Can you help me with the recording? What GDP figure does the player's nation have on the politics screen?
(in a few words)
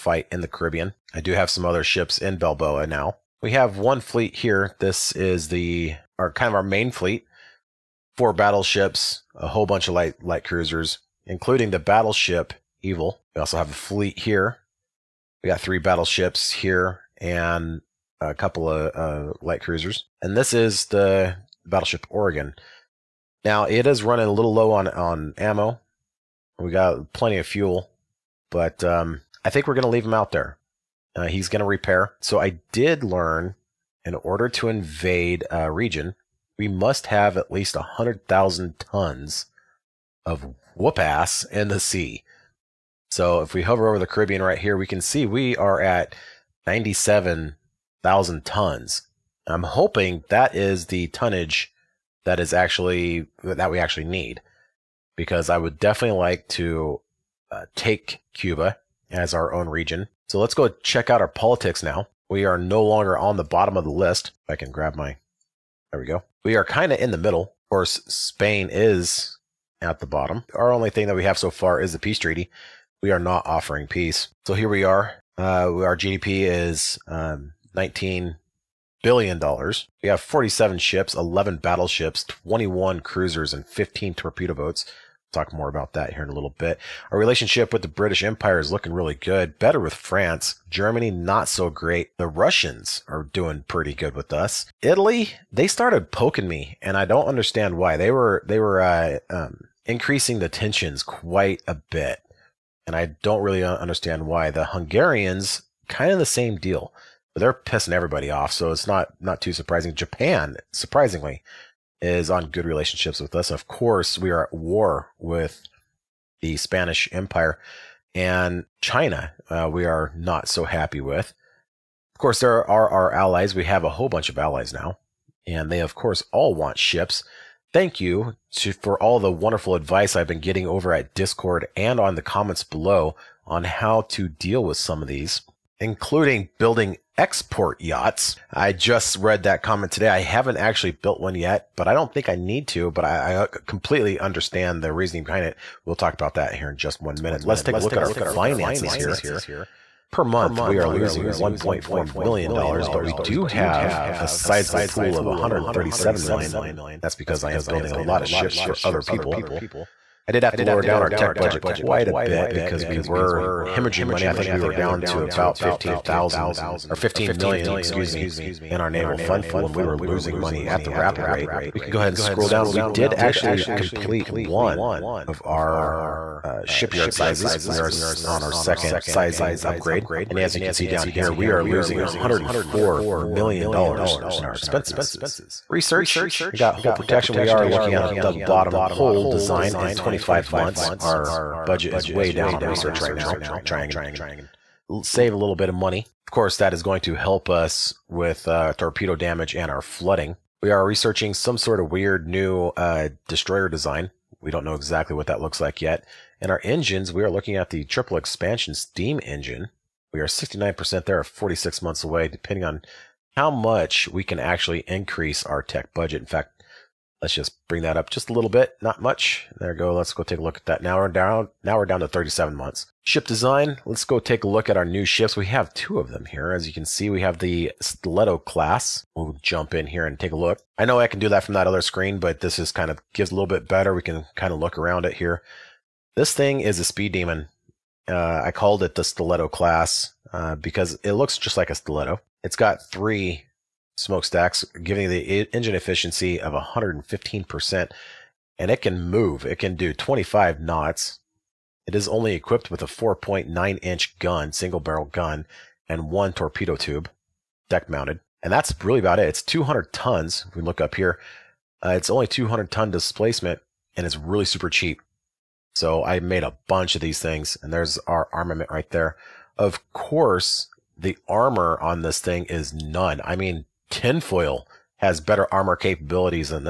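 $19 billion.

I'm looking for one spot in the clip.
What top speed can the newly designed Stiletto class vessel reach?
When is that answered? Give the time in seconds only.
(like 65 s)
249 s.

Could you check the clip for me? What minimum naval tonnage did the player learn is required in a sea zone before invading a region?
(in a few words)
100,000 tons.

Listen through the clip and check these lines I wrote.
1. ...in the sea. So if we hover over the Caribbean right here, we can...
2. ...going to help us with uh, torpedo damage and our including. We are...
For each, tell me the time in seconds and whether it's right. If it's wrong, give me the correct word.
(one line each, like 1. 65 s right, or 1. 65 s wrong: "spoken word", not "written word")
1. 41 s right
2. 196 s wrong: "flooding", not "including".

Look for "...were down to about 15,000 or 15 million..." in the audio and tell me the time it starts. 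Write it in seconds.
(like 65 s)
164 s.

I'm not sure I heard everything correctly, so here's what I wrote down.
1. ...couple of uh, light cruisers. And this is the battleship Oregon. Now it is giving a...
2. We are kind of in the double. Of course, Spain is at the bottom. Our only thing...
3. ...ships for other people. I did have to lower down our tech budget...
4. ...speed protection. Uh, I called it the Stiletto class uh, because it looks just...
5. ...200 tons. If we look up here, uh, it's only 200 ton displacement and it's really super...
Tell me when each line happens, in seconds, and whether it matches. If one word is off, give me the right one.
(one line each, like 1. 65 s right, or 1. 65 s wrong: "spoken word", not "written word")
1. 18 s wrong: "running", not "giving"
2. 66 s wrong: "middle", not "double"
3. 158 s right
4. 236 s wrong: "demon", not "protection"
5. 259 s right.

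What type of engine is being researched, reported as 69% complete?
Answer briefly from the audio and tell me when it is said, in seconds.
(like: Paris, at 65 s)
triple expansion steam engine, at 207 s.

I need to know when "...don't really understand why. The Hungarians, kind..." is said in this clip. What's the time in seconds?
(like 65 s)
103 s.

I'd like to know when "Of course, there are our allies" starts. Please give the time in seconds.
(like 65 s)
122 s.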